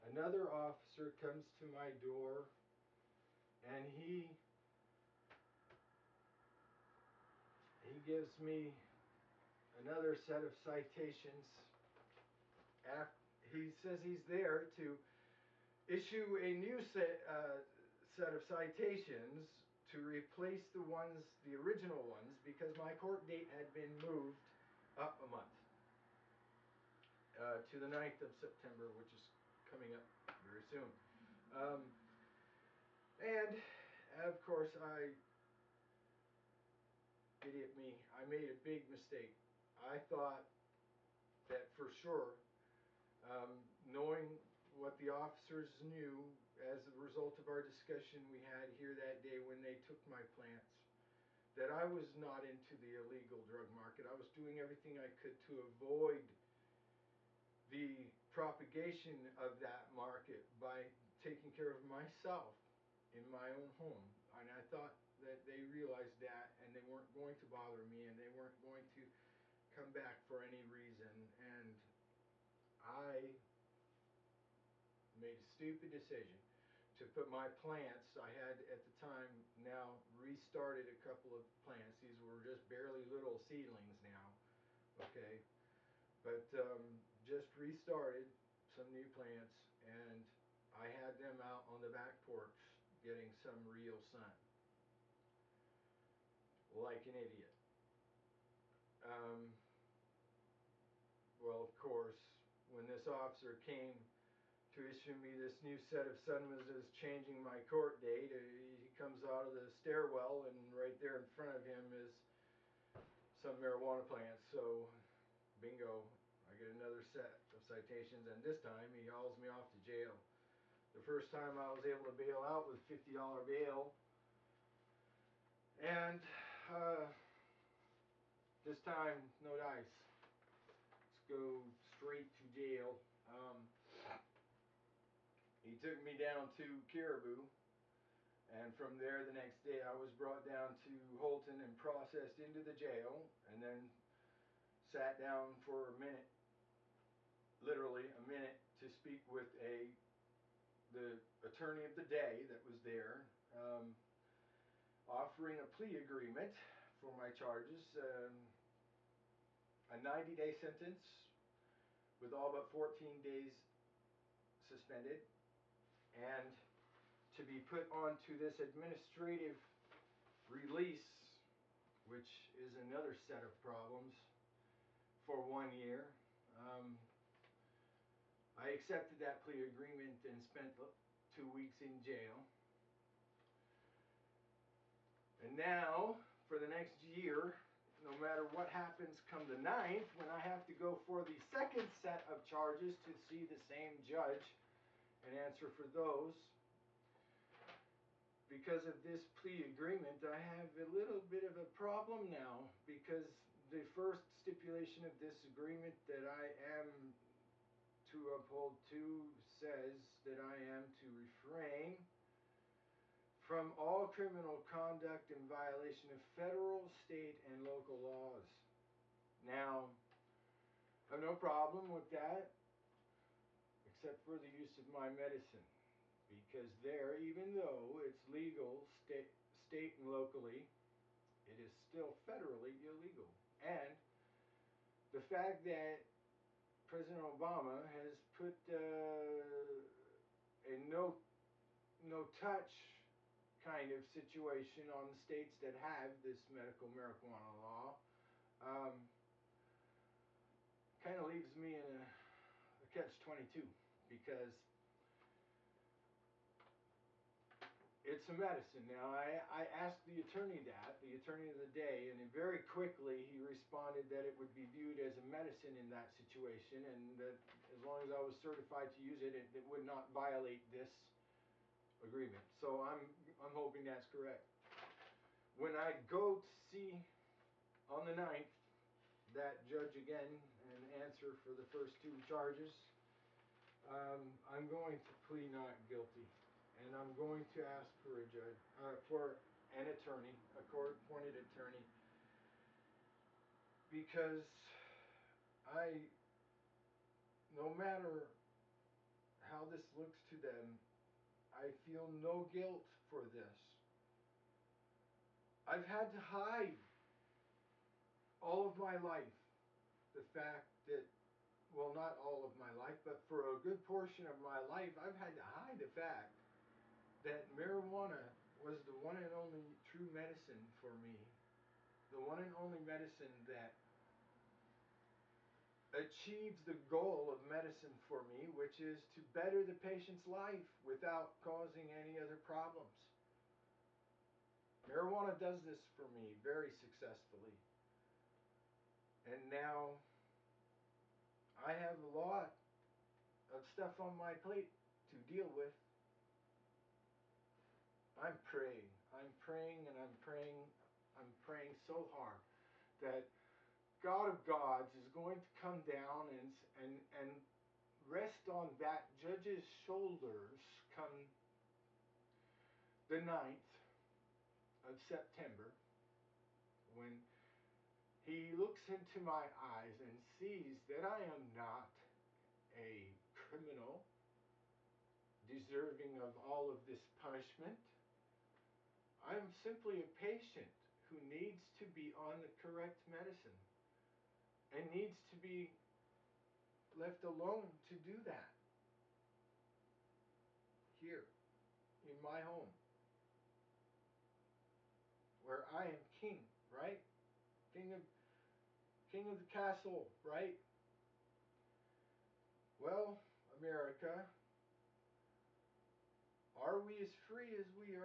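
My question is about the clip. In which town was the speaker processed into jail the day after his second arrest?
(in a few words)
Houlton.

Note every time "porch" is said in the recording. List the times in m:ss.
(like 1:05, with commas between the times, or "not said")
1:32.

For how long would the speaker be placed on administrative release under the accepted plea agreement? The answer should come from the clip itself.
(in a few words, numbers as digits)
1 year.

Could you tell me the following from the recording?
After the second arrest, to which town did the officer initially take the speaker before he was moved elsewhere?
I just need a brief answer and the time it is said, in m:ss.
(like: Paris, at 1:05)
Caribou, at 2:16.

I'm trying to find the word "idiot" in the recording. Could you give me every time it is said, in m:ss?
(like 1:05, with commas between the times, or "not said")
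0:37, 1:37.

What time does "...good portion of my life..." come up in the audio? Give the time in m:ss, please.
5:13.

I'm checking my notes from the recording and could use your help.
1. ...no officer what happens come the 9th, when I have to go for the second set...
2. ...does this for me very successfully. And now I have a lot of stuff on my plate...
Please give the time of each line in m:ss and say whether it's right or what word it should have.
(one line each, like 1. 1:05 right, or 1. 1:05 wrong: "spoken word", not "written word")
1. 3:08 wrong: "matter", not "officer"
2. 5:35 right.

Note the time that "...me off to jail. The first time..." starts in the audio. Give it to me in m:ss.
1:59.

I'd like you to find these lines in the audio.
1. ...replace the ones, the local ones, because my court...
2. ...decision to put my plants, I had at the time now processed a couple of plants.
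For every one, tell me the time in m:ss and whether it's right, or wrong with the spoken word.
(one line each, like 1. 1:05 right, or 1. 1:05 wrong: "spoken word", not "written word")
1. 0:20 wrong: "original", not "local"
2. 1:15 wrong: "restarted", not "processed".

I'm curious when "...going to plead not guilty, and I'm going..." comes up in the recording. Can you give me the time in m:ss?
4:44.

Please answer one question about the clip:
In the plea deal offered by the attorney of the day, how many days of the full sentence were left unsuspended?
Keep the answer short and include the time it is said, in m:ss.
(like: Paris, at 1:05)
14 days, at 2:42.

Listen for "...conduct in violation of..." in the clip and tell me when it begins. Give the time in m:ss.
3:34.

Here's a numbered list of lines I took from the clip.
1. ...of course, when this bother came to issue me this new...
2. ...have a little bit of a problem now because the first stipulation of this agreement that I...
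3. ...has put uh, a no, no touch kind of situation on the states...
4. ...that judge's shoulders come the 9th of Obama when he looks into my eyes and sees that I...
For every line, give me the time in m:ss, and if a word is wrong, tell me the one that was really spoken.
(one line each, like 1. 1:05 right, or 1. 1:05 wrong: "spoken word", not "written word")
1. 1:41 wrong: "officer", not "bother"
2. 3:20 right
3. 3:57 right
4. 5:58 wrong: "September", not "Obama".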